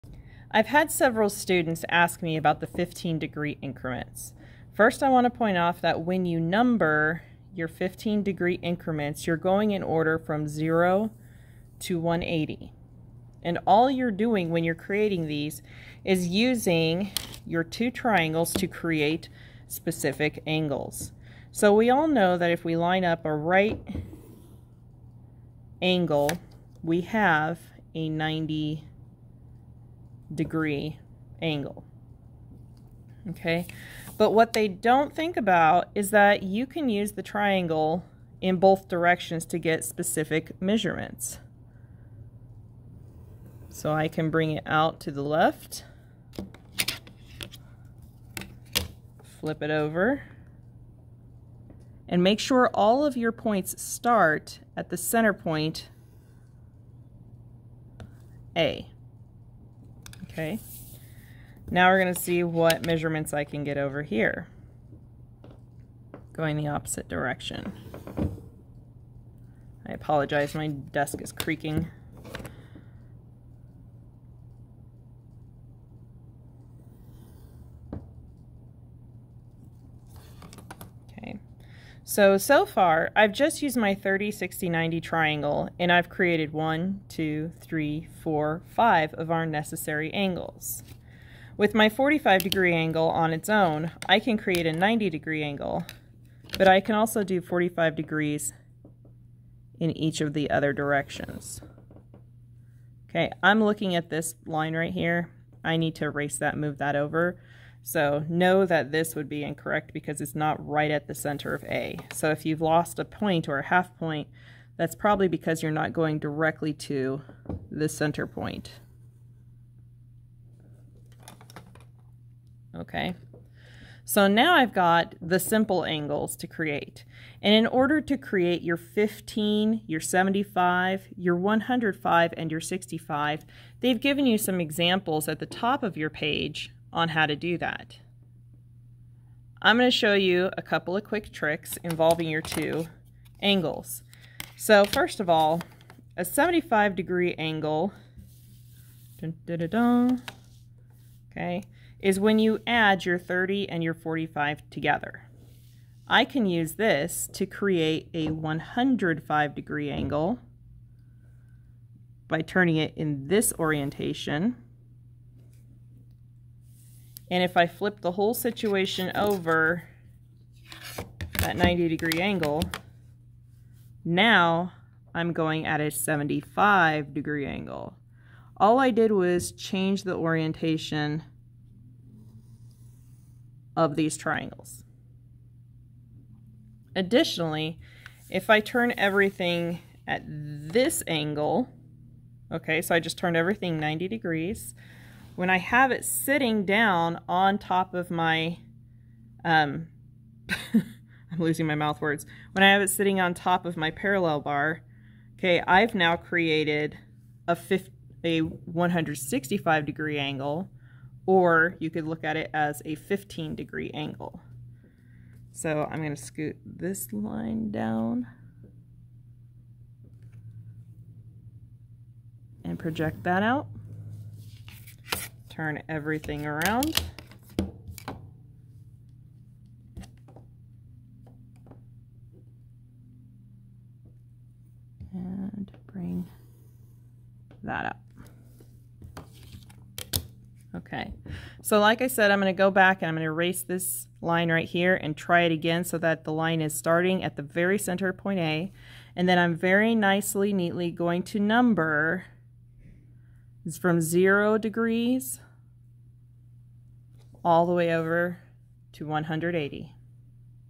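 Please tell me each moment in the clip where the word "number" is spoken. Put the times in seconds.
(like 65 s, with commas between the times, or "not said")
6 s, 251 s.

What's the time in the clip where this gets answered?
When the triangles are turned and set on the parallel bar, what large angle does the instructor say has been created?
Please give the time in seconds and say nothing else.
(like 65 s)
208 s.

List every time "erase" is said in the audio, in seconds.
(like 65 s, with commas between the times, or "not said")
106 s, 243 s.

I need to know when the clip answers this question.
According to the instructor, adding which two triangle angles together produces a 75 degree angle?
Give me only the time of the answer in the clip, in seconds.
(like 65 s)
153 s.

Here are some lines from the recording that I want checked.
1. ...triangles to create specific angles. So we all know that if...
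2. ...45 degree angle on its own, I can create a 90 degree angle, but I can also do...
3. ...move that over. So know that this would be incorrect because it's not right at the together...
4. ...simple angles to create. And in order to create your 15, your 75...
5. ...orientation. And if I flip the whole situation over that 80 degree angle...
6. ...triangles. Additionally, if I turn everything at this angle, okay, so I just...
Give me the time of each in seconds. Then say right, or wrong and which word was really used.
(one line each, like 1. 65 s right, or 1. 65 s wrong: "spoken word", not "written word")
1. 17 s right
2. 91 s right
3. 106 s wrong: "center", not "together"
4. 125 s right
5. 163 s wrong: "90", not "80"
6. 184 s right.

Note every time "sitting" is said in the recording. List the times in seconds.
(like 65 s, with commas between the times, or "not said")
196 s, 202 s.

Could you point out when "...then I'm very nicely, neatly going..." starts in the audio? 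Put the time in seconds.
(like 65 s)
249 s.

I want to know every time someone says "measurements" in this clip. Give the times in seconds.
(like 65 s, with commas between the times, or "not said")
40 s, 62 s.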